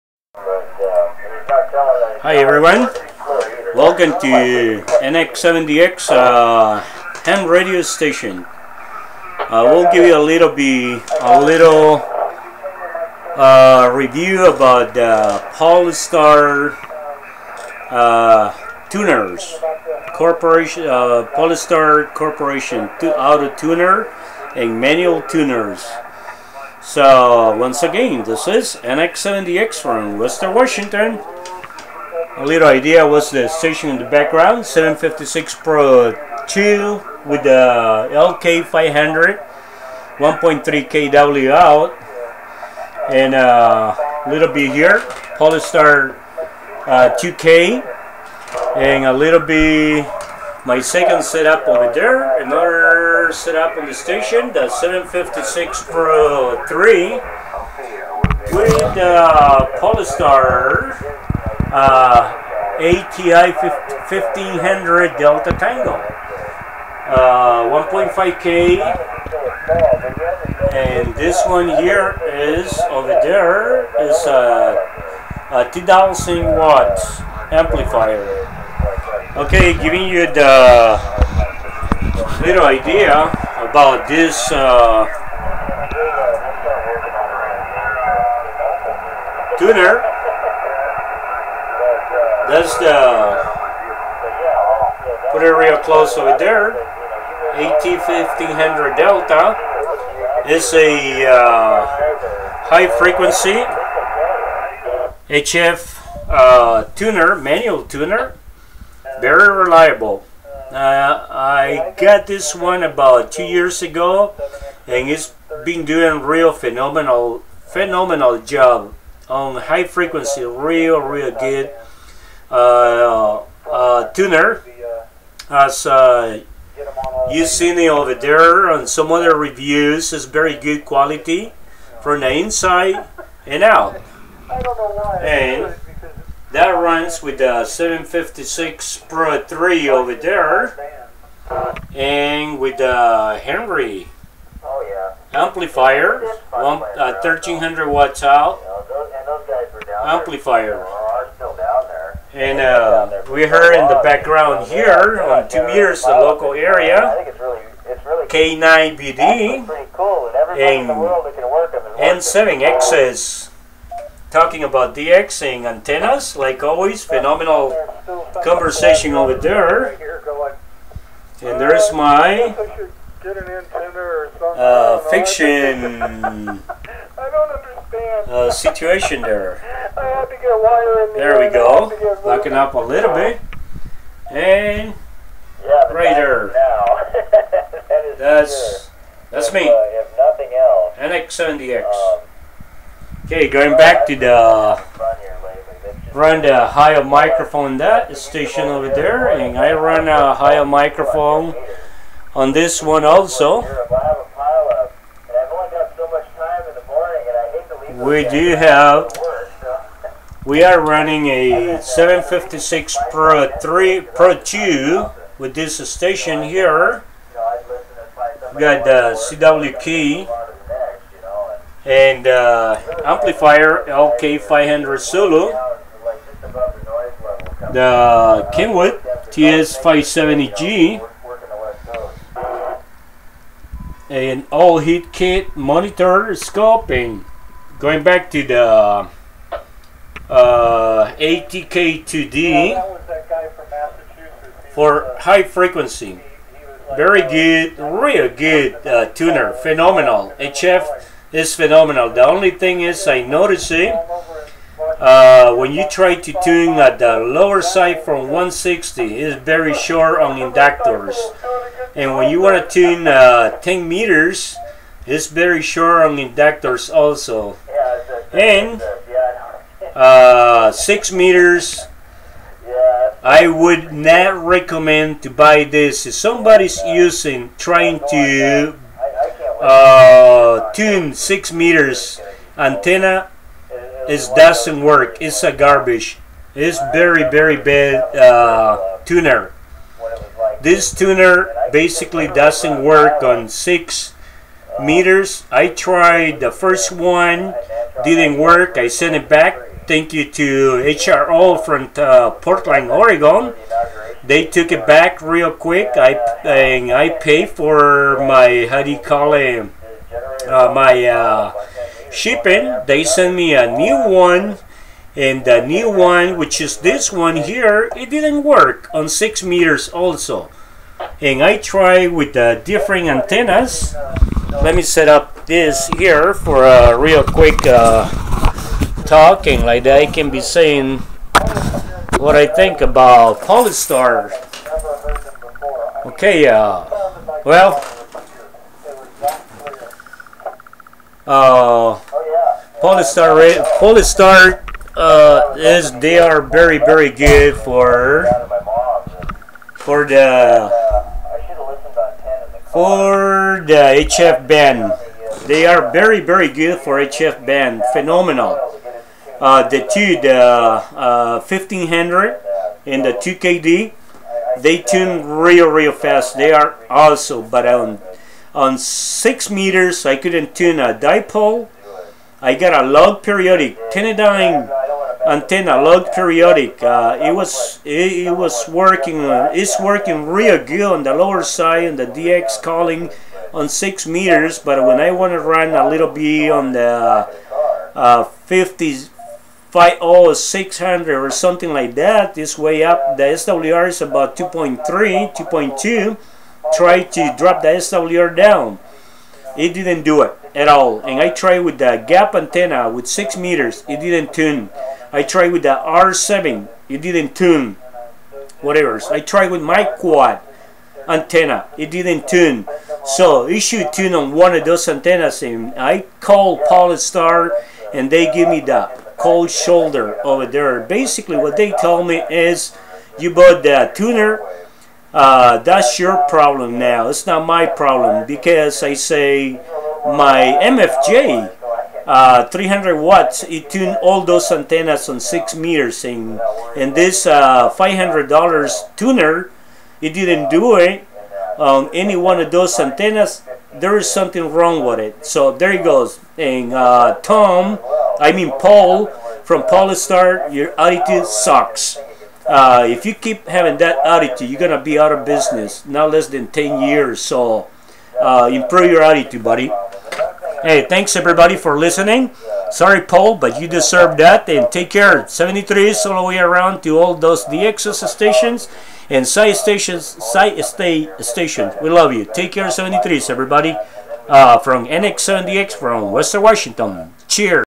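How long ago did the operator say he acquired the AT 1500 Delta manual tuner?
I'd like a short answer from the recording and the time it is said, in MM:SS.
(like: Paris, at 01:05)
About two years ago, at 01:52.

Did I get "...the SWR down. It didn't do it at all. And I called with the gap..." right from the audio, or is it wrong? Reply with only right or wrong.
wrong.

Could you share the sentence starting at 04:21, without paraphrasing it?
And when you want to tune uh, 10 meters, it's very short on inductors also.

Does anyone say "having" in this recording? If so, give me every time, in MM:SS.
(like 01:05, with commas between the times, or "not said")
07:33.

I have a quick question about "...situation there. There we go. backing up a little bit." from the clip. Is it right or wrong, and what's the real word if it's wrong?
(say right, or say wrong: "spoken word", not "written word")
right.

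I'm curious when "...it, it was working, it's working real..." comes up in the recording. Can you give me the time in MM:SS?
06:17.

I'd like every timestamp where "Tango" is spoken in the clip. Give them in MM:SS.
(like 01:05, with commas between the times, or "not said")
01:05.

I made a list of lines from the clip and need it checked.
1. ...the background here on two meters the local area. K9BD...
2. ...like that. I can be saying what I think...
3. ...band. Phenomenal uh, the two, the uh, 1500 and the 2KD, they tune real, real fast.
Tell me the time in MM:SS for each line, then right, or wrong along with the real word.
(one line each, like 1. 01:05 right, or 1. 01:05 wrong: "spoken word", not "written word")
1. 02:33 right
2. 05:29 right
3. 05:57 right.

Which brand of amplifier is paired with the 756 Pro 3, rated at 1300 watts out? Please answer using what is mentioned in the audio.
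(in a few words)
Henry.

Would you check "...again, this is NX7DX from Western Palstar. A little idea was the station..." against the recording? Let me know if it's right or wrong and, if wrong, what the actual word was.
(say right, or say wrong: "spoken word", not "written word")
wrong: "Washington", not "Palstar".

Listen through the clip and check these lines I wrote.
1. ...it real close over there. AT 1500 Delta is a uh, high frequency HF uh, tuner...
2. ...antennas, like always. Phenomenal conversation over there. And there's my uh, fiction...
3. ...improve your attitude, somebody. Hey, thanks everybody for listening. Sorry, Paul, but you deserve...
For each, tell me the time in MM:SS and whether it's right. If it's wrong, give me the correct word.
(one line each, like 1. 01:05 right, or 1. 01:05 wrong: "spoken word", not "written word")
1. 01:35 right
2. 02:45 right
3. 07:38 wrong: "buddy", not "somebody".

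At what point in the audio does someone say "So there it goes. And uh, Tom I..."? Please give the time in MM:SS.
07:25.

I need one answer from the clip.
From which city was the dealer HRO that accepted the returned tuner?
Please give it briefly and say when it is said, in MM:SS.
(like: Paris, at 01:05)
Portland, Oregon, at 05:02.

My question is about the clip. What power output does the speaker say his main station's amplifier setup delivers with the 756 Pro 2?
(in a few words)
1.3 kW.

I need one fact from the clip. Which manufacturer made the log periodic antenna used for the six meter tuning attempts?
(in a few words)
Tennadyne.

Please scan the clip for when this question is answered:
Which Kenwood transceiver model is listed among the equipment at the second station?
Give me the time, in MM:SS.
03:49.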